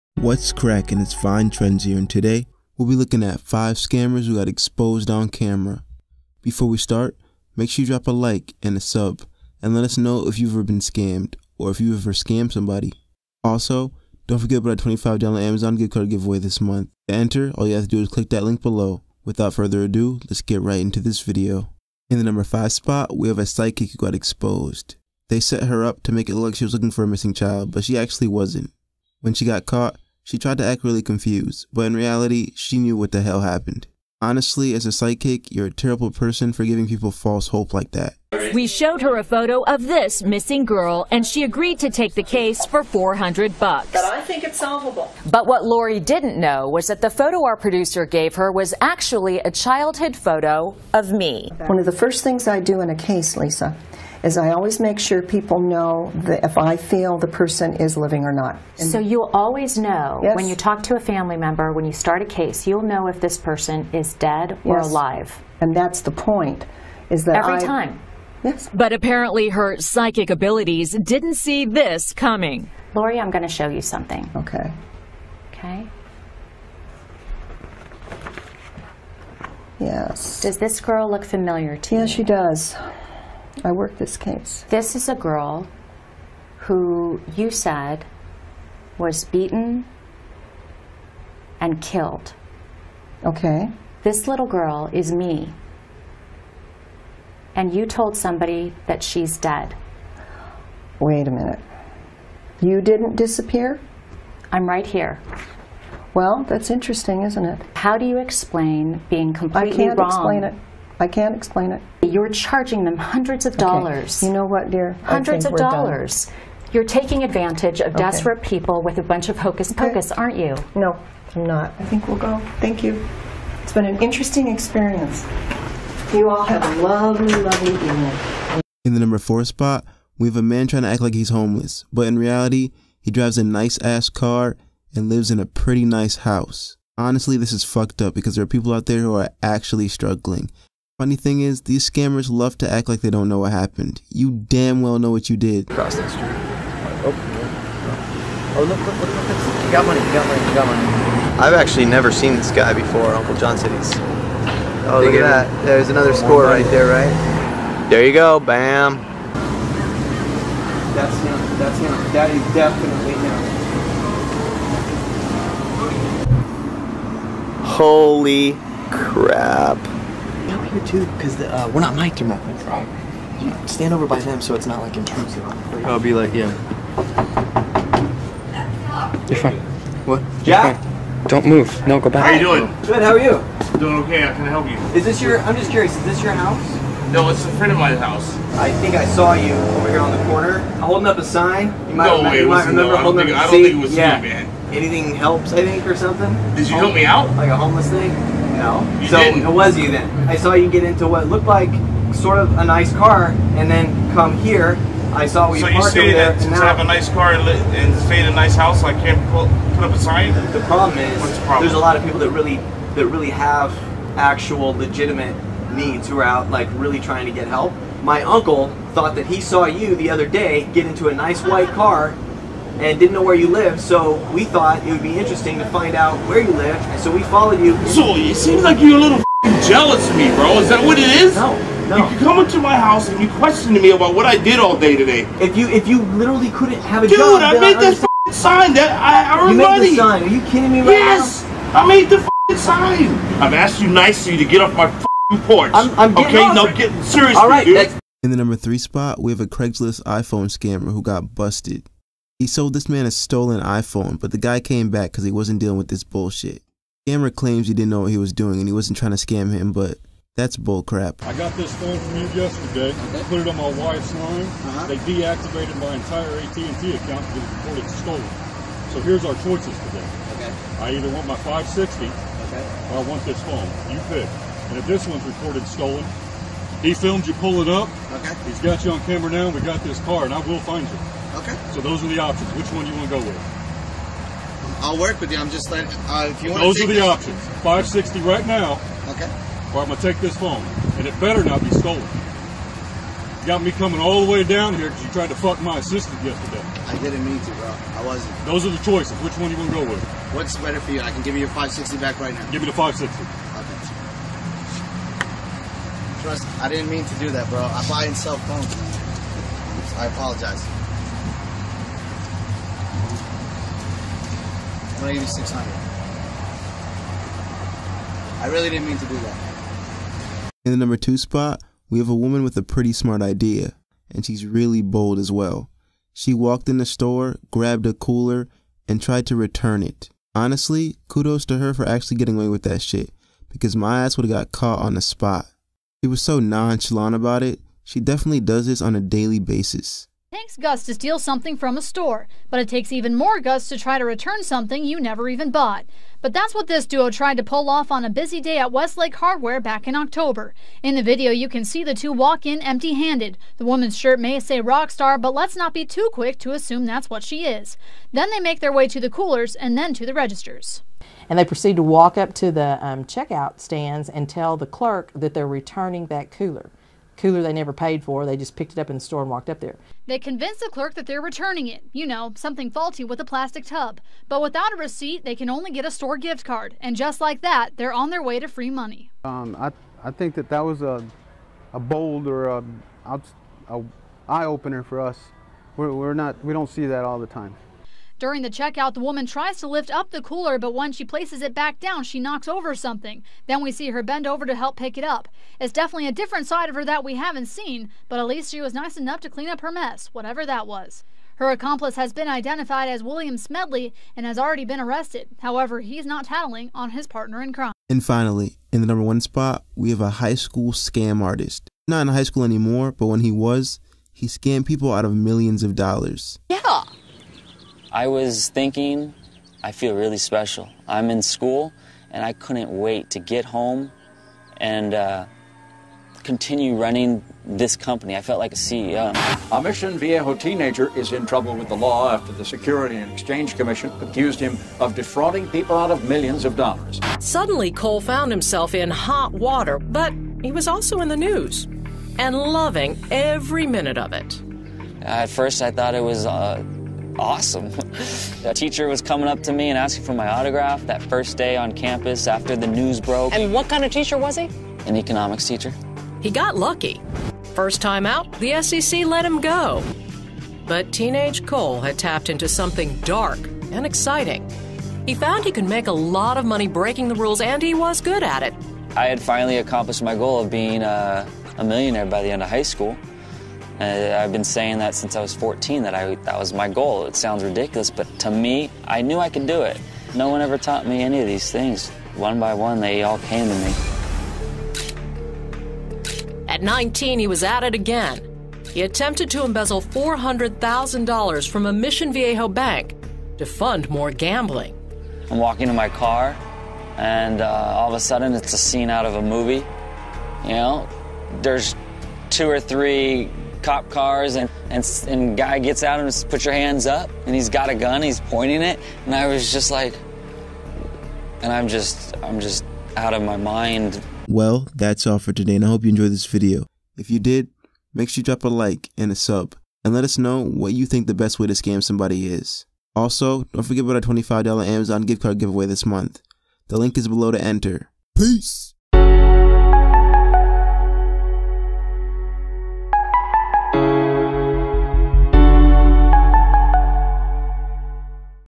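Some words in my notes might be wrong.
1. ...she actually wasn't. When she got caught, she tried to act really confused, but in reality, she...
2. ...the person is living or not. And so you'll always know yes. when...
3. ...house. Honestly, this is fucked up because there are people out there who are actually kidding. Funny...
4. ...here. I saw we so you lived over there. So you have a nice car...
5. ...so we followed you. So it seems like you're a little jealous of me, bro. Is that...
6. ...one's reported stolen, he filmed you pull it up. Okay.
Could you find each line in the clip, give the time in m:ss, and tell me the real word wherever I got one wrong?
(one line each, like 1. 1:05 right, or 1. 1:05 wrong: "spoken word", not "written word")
1. 0:27 right
2. 0:57 right
3. 2:16 wrong: "struggling", not "kidding"
4. 3:24 wrong: "parked", not "lived"
5. 3:46 right
6. 4:35 right.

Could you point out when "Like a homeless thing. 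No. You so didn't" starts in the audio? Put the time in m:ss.
3:17.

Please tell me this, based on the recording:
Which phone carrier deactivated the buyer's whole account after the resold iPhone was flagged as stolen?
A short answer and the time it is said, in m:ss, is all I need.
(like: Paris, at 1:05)
AT&T, at 4:26.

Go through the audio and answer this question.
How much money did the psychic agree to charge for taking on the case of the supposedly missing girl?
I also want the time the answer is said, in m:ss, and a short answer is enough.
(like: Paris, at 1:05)
$400, at 0:42.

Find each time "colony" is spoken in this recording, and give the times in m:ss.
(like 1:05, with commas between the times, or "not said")
not said.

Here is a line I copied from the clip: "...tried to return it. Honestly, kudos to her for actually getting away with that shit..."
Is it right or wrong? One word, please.
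right.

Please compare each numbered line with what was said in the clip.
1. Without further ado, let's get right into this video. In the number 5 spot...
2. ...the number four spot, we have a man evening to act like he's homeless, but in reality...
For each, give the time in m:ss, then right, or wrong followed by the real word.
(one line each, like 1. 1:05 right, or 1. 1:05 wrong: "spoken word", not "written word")
1. 0:19 right
2. 2:08 wrong: "trying", not "evening".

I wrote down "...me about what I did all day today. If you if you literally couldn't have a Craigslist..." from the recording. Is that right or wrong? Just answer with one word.
wrong.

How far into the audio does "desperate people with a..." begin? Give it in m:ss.
1:58.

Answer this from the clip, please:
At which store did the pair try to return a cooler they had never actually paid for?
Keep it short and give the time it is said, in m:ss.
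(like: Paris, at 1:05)
Westlake Hardware, at 5:48.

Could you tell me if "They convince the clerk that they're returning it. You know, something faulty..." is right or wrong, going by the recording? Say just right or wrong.
right.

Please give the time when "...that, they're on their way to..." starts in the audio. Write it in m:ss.
6:17.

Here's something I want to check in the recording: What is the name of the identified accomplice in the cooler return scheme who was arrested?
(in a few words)
William Smedley.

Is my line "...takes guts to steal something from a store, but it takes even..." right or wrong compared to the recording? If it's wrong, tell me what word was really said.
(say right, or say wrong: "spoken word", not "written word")
right.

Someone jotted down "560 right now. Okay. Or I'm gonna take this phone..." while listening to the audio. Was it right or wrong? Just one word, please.
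right.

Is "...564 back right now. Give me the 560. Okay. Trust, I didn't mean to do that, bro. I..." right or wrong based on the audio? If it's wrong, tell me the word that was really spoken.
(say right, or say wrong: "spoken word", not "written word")
wrong: "560", not "564".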